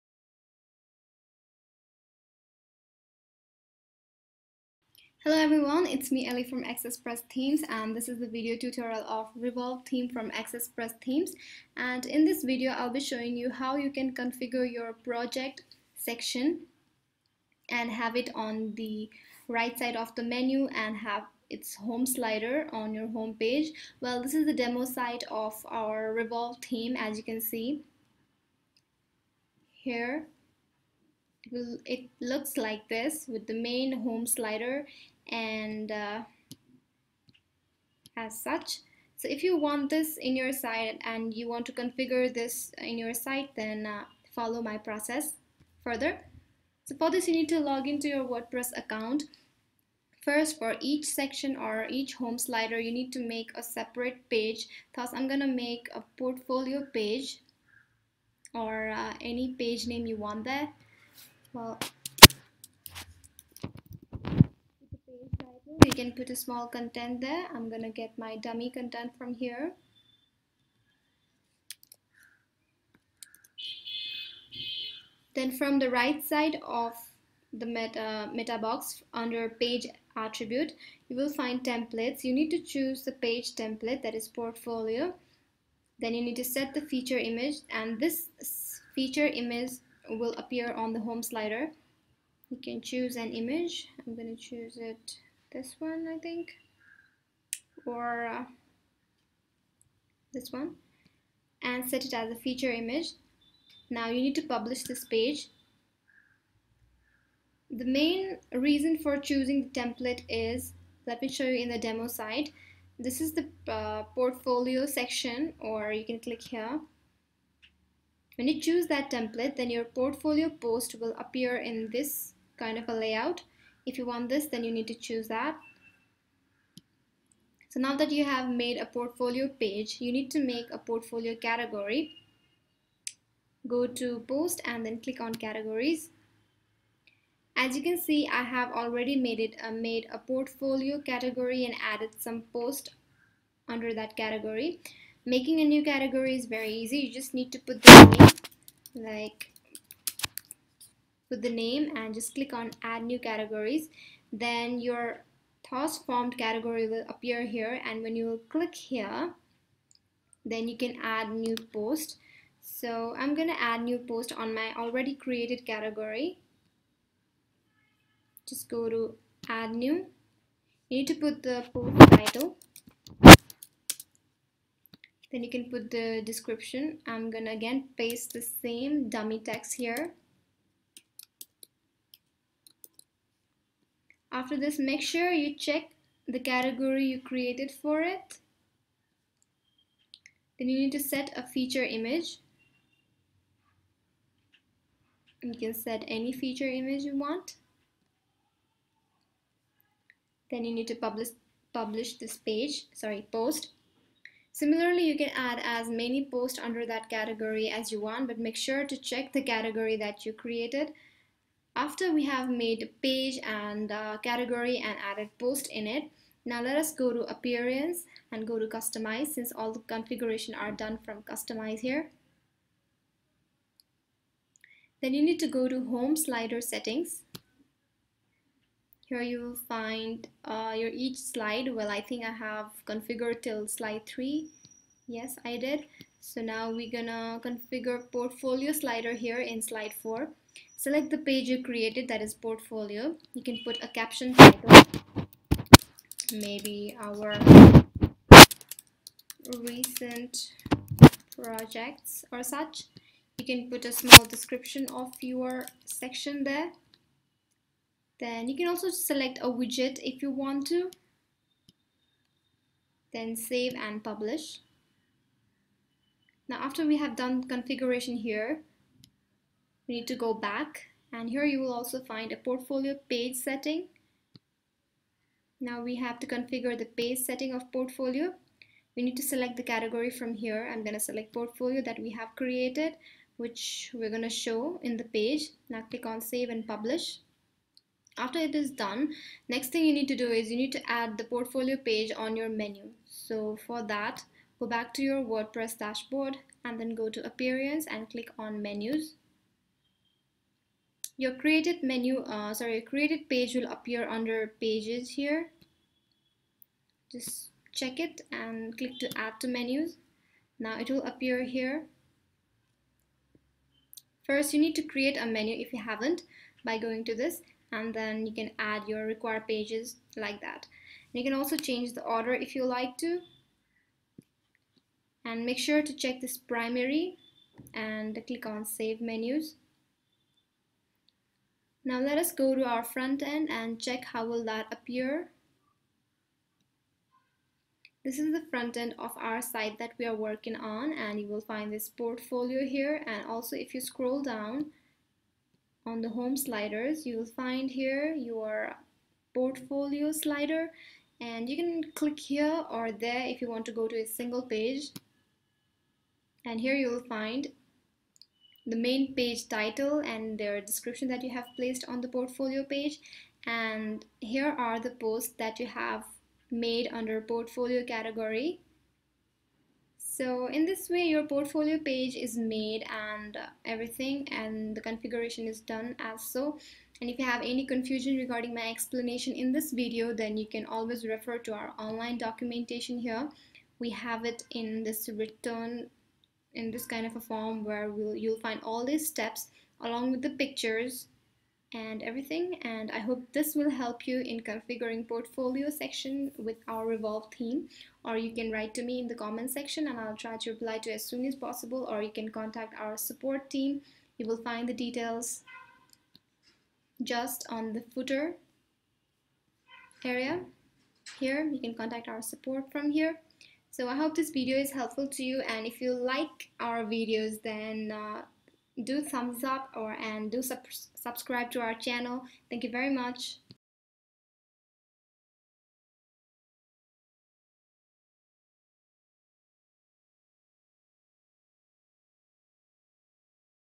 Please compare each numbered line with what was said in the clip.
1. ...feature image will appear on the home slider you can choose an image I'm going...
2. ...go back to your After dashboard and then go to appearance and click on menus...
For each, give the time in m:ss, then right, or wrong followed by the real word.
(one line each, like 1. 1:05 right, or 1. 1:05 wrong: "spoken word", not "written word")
1. 1:28 right
2. 4:54 wrong: "WordPress", not "After".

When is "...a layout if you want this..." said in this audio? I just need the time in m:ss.
2:02.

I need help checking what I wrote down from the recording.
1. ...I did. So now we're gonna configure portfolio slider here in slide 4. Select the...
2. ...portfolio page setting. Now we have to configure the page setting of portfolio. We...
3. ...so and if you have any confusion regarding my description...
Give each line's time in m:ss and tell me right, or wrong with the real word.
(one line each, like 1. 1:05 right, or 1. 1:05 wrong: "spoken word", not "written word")
1. 3:55 right
2. 4:32 right
3. 6:16 wrong: "explanation", not "description".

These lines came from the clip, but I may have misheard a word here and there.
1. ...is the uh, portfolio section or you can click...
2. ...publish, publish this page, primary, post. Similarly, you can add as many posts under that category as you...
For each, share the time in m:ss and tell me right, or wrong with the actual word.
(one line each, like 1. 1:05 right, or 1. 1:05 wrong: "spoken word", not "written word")
1. 1:53 right
2. 3:20 wrong: "sorry", not "primary".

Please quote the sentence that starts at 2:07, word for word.
So now that you have made a portfolio page, you need to make a portfolio category.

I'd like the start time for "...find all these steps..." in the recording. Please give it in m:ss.
6:28.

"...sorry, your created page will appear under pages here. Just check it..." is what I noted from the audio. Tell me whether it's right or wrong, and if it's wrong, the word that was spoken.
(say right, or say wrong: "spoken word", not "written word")
right.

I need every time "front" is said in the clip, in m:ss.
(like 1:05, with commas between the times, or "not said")
5:32, 5:38.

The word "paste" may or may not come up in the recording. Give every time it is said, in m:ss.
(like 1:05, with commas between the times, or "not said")
2:57.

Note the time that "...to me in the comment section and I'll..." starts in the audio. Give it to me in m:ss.
6:38.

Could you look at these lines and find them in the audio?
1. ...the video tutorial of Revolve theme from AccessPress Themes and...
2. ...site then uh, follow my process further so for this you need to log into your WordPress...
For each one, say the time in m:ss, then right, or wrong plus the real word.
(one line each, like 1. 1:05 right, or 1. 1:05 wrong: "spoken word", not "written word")
1. 0:08 right
2. 0:43 right.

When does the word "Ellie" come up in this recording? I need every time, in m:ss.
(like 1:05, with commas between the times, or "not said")
0:06.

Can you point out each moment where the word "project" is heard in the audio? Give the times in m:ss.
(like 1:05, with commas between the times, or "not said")
0:14, 4:11.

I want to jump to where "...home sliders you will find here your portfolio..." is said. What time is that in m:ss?
5:46.